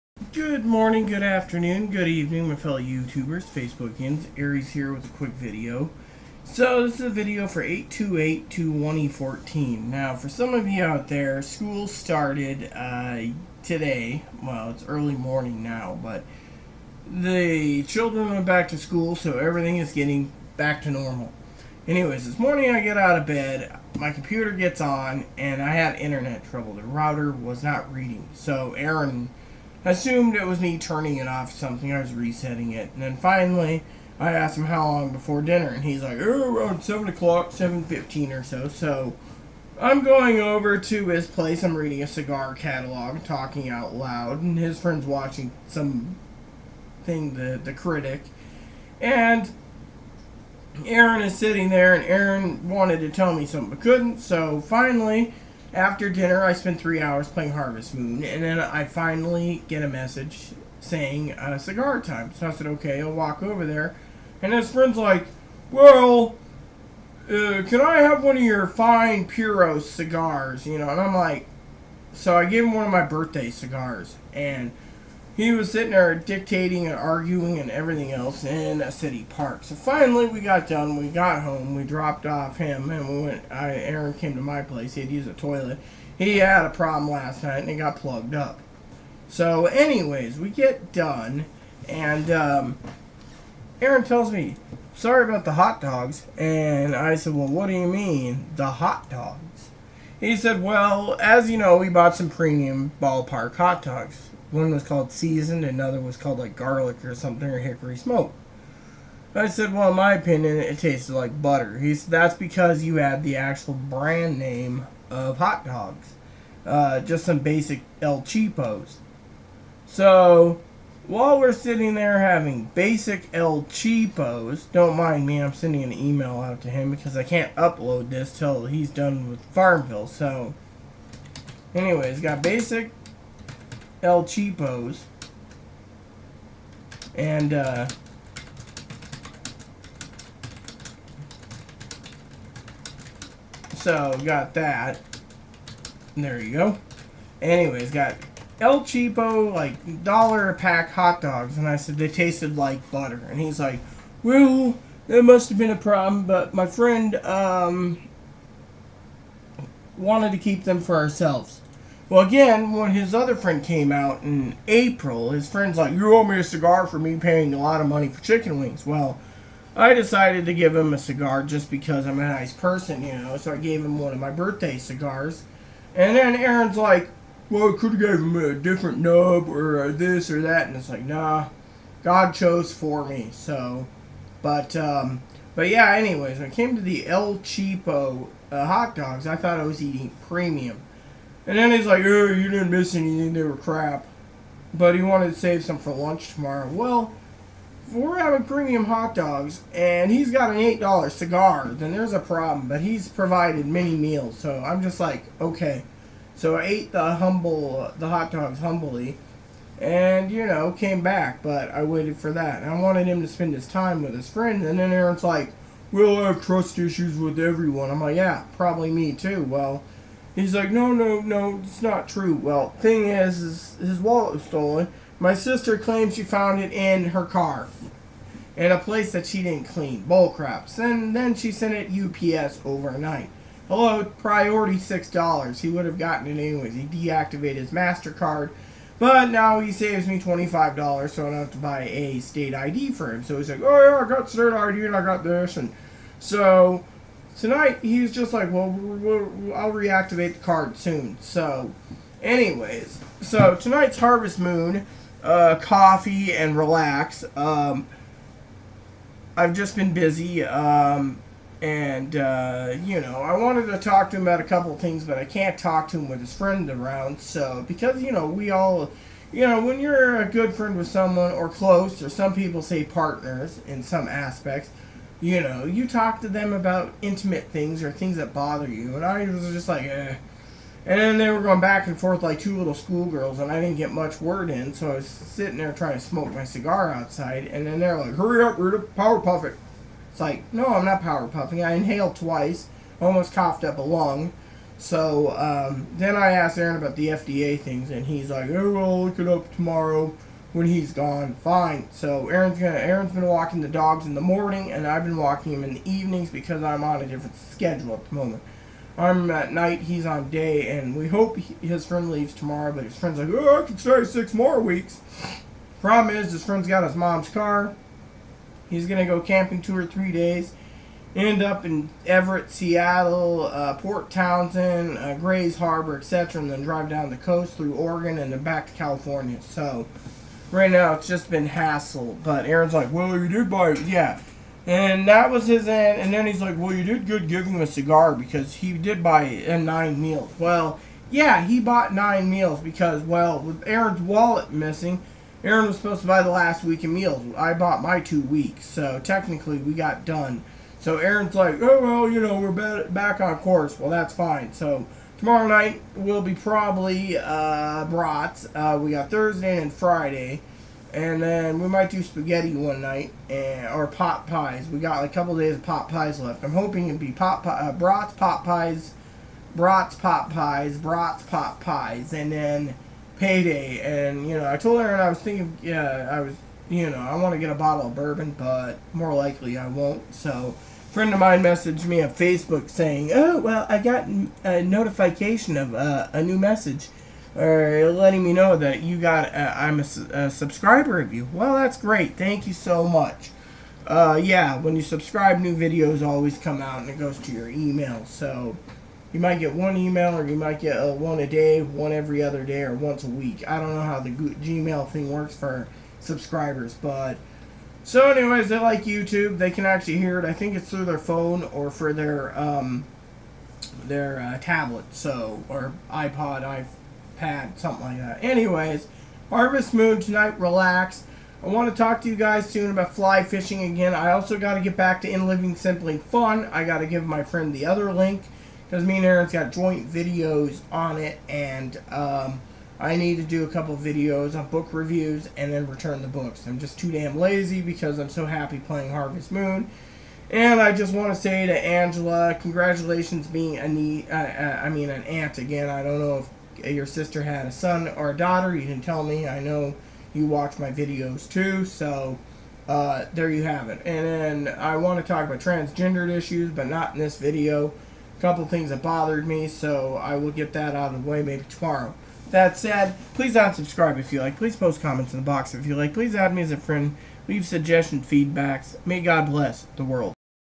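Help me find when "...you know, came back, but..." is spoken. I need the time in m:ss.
3:30.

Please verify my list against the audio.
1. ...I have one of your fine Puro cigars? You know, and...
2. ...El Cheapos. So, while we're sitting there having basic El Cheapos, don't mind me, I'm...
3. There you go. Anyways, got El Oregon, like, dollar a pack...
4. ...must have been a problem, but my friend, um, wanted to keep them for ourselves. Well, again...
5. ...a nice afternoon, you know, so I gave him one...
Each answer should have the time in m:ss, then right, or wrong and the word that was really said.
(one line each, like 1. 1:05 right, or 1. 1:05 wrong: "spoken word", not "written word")
1. 1:07 right
2. 1:58 right
3. 2:26 wrong: "Cheapo", not "Oregon"
4. 2:35 right
5. 2:52 wrong: "person", not "afternoon".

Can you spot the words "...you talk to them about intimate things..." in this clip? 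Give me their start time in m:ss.
4:35.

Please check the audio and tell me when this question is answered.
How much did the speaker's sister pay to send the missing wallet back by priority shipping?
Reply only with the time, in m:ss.
3:54.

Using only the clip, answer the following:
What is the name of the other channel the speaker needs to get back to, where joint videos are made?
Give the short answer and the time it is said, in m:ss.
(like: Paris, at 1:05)
In Living Simply Fun, at 7:05.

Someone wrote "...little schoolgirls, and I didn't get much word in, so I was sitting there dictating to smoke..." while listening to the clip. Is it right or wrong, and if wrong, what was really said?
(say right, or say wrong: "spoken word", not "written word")
wrong: "trying", not "dictating".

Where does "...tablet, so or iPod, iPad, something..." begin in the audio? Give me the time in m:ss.
6:54.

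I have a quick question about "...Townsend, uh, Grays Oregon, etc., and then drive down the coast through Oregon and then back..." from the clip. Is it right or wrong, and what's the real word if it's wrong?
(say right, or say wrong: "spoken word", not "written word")
wrong: "Harbor", not "Oregon".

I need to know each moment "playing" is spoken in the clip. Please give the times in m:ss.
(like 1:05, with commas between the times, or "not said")
0:57, 7:18.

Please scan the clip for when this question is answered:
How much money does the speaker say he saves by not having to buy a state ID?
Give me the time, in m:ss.
4:00.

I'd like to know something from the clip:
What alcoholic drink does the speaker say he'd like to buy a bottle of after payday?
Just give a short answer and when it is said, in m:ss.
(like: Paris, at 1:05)
bourbon, at 6:17.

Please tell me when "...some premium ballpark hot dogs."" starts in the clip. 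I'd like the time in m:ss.
1:42.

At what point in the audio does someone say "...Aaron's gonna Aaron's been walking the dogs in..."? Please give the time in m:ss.
5:02.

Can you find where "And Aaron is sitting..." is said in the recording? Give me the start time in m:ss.
0:48.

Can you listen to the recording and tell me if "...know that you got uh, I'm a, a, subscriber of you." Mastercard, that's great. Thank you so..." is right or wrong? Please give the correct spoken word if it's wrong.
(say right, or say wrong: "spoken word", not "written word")
wrong: "Well", not "Mastercard".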